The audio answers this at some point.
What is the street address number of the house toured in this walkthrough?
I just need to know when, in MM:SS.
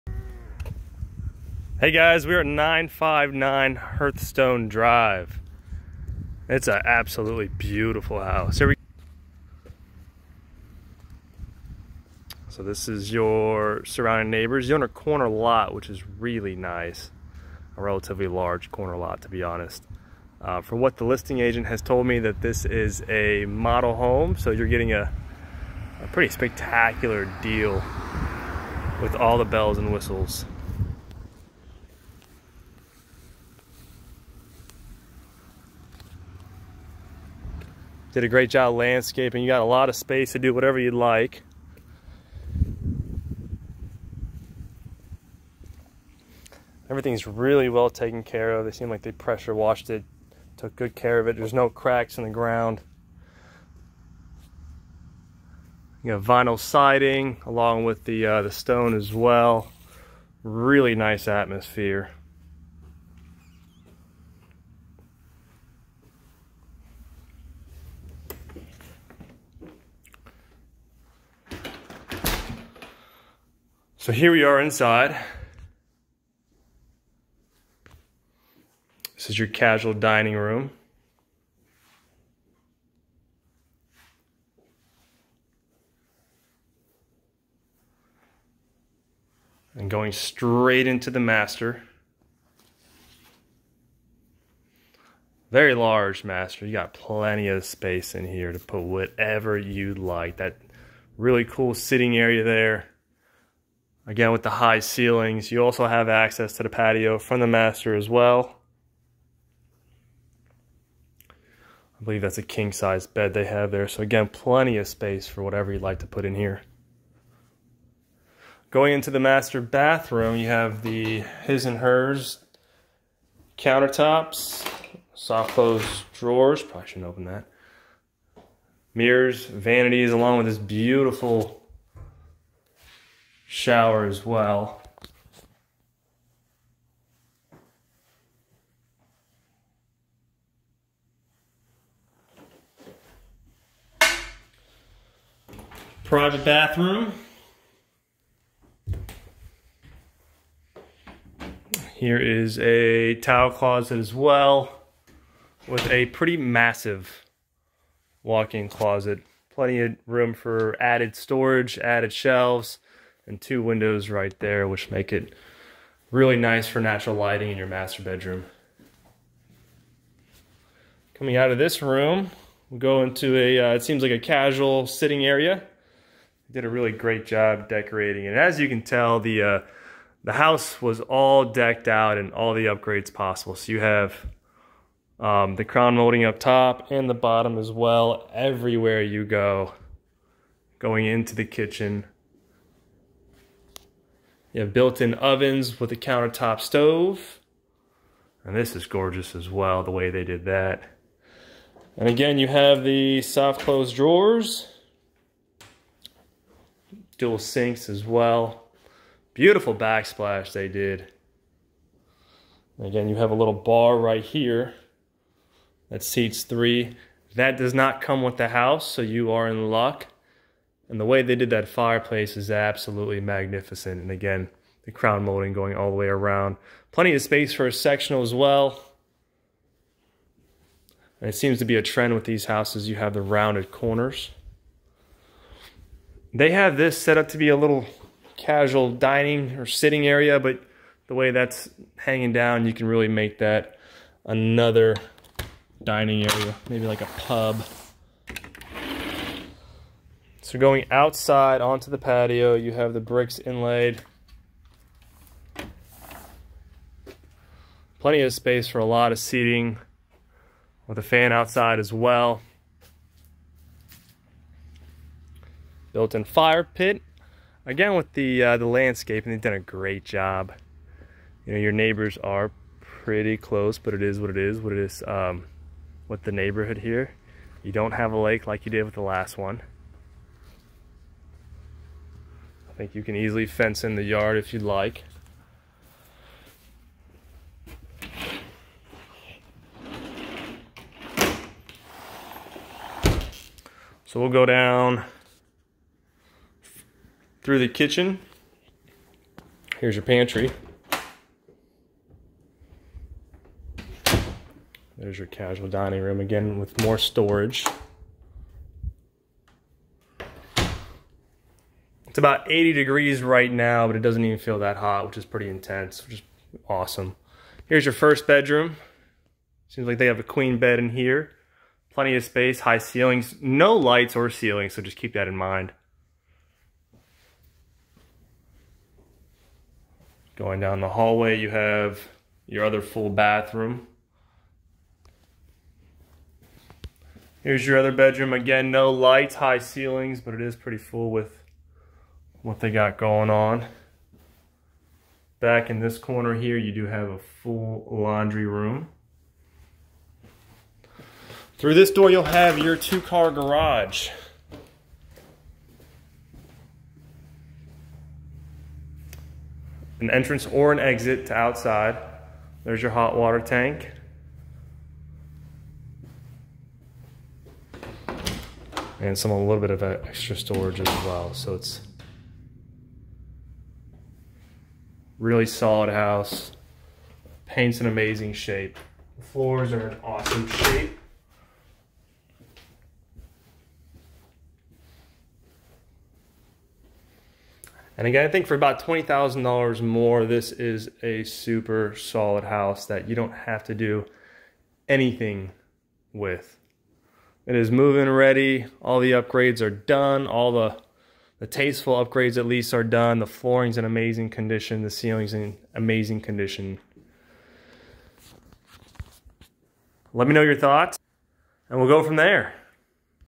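00:02.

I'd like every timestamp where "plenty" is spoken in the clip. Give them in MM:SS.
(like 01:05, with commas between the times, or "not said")
01:36, 01:54, 02:39, 03:46, 04:17, 05:21.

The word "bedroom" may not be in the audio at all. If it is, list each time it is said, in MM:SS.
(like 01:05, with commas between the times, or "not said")
02:48, 05:18, 05:37.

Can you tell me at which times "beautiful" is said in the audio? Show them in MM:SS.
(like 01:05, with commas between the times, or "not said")
00:07, 02:10, 03:29.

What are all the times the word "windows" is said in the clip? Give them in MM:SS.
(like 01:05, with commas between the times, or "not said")
02:43.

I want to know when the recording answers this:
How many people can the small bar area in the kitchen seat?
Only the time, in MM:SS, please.
03:36.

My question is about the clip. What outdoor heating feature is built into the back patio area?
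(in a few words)
Fire pit.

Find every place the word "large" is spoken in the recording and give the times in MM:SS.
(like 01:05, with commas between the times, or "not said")
00:18, 01:35.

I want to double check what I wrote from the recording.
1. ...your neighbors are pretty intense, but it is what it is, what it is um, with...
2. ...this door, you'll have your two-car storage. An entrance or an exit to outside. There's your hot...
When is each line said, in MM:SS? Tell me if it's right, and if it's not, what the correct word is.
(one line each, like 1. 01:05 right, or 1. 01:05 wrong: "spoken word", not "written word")
1. 04:31 wrong: "close", not "intense"
2. 05:51 wrong: "garage", not "storage".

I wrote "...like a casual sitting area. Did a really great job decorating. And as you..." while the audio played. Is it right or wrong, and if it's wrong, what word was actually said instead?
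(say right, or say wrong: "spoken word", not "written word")
right.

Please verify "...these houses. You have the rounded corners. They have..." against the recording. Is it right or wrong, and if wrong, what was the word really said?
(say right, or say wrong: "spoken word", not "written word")
right.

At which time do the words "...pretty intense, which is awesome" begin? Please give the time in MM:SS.
05:15.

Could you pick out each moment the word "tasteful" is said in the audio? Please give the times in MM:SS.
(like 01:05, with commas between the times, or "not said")
06:41.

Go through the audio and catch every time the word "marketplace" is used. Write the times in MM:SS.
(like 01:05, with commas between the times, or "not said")
not said.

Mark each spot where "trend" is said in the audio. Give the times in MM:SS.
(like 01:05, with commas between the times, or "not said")
03:51.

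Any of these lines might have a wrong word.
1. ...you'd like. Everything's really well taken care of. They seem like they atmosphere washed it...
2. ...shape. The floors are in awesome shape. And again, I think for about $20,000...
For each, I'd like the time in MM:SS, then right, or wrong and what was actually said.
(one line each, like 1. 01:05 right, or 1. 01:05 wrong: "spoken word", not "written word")
1. 00:40 wrong: "pressure", not "atmosphere"
2. 06:18 right.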